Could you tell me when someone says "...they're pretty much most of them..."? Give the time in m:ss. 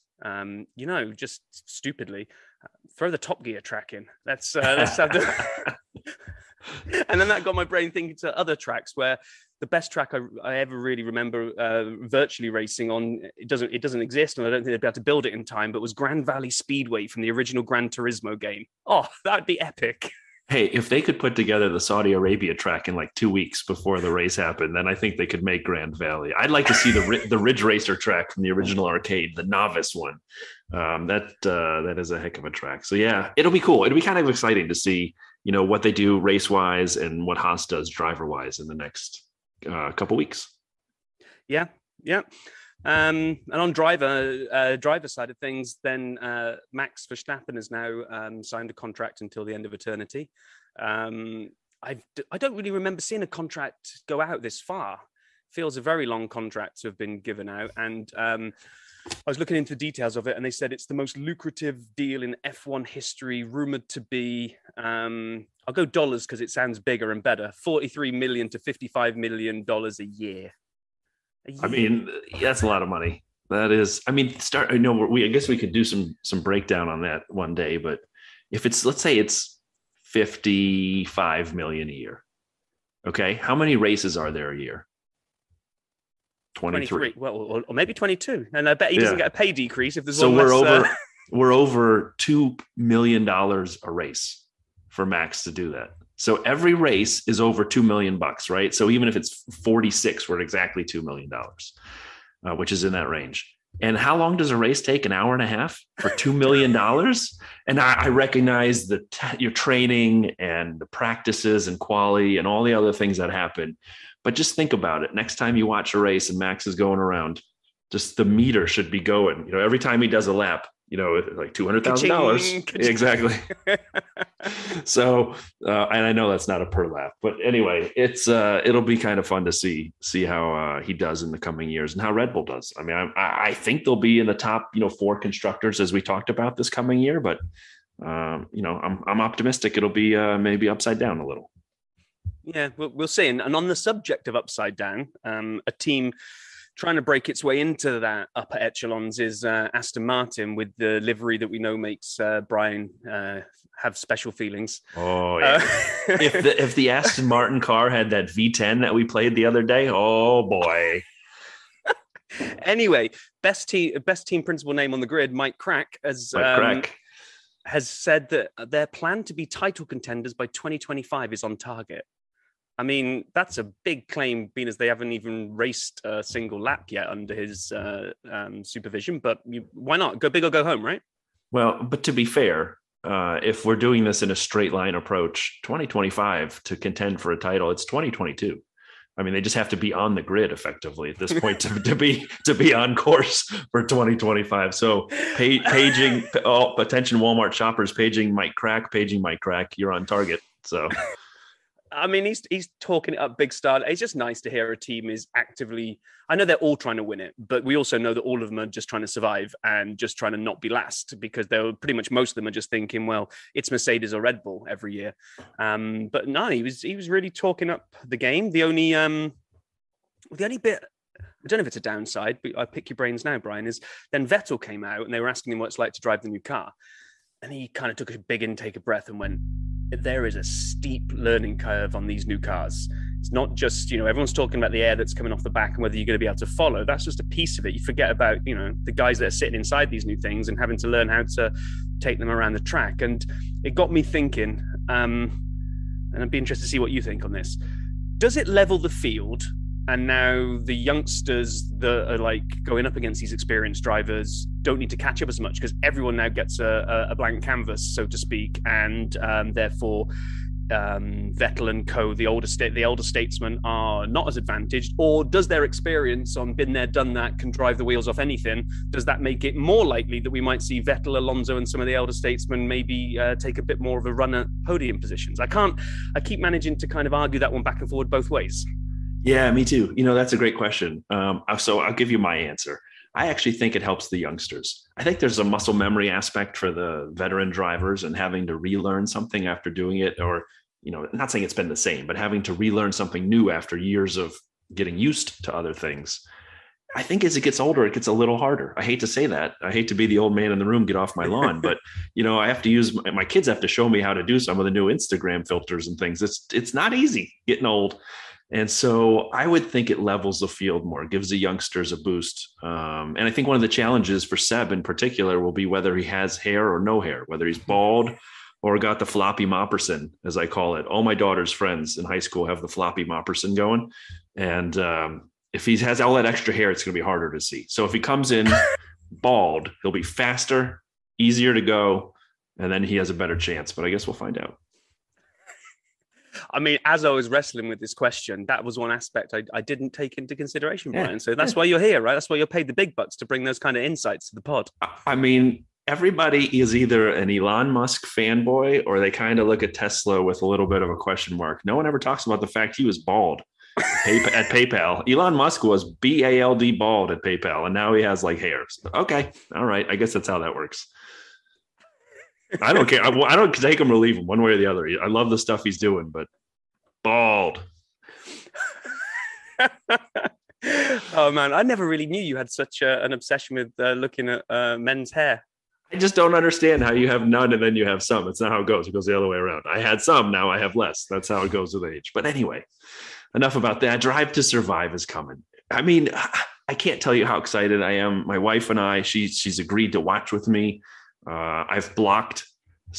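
3:31.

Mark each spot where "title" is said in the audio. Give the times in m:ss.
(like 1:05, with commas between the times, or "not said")
2:49, 3:07.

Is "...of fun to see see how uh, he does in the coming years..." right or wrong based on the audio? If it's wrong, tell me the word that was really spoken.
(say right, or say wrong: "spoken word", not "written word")
right.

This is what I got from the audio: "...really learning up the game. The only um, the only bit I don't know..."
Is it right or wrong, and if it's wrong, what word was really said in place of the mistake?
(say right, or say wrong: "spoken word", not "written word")
wrong: "talking", not "learning".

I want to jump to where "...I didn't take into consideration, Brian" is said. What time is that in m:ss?
5:39.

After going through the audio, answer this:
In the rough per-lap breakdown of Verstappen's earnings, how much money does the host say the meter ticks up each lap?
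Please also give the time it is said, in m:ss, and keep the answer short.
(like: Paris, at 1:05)
200,000 dollars, at 2:01.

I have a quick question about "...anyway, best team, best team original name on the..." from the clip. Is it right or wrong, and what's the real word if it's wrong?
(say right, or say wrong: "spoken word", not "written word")
wrong: "principal", not "original".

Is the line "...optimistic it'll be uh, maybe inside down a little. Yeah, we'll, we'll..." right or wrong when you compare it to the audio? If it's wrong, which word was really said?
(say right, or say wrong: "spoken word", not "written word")
wrong: "upside", not "inside".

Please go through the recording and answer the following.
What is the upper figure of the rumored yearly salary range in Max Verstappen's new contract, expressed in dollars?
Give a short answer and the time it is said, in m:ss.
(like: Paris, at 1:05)
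55 million dollars, at 1:08.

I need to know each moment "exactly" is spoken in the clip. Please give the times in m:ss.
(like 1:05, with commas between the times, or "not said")
1:40, 2:02.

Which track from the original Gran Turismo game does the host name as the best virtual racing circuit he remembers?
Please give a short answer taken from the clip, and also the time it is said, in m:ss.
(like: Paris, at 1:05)
Grand Valley Speedway, at 0:15.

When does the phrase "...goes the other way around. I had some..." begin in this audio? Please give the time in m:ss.
6:18.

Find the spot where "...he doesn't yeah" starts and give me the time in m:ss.
1:28.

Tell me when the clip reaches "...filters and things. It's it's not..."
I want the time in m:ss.
5:05.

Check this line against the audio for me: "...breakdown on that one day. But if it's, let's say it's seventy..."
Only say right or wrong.
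wrong.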